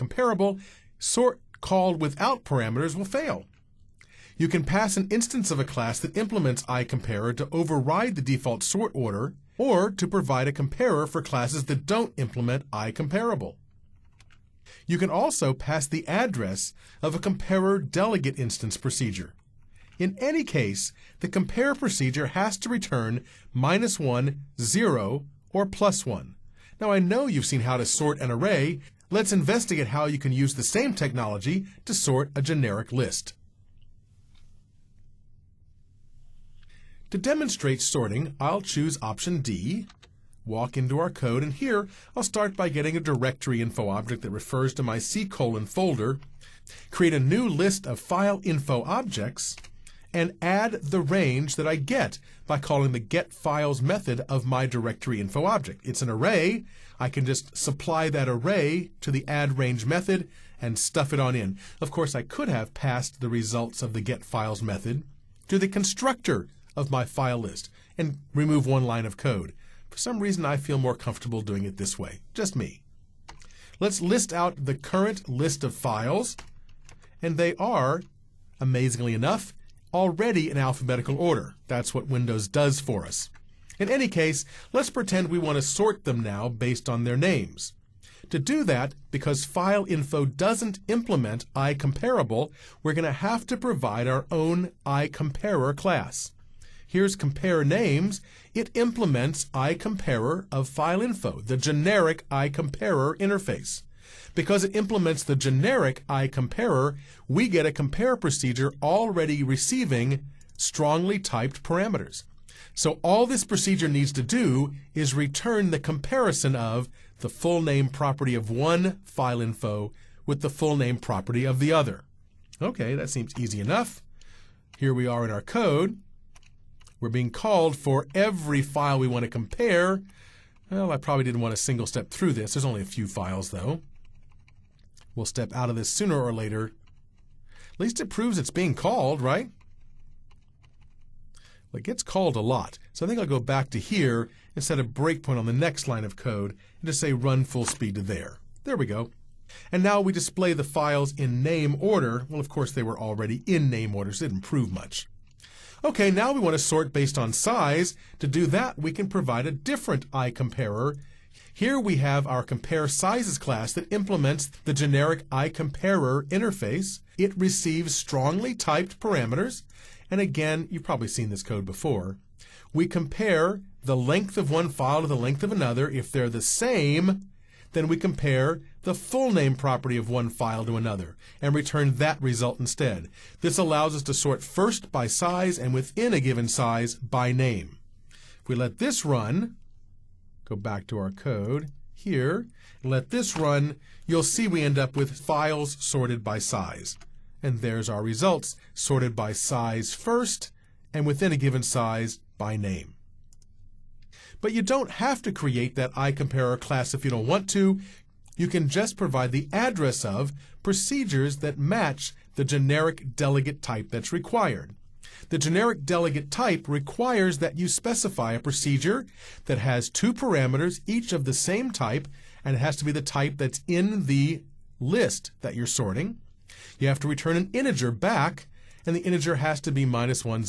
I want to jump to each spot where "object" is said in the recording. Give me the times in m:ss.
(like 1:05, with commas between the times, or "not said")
0:43, 0:48, 0:55.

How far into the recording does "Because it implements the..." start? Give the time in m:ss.
1:44.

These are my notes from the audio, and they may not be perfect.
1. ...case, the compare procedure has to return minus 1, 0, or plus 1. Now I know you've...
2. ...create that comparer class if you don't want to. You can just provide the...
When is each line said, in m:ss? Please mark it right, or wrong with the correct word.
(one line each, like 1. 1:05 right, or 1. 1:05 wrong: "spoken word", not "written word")
1. 0:20 right
2. 3:25 wrong: "iComparer", not "comparer".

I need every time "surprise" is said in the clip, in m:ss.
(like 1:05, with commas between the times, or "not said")
not said.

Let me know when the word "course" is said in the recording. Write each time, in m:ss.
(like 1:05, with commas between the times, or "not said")
1:01, 2:32.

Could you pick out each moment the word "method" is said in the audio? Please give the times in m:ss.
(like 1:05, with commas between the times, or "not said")
0:53, 0:59, 1:04.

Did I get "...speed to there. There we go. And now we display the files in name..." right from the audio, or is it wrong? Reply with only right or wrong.
right.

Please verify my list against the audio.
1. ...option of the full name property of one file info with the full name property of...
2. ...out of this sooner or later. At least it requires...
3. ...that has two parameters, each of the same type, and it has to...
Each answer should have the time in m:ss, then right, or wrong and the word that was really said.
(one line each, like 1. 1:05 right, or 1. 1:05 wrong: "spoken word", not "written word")
1. 1:55 wrong: "comparison", not "option"
2. 2:15 wrong: "proves", not "requires"
3. 3:39 right.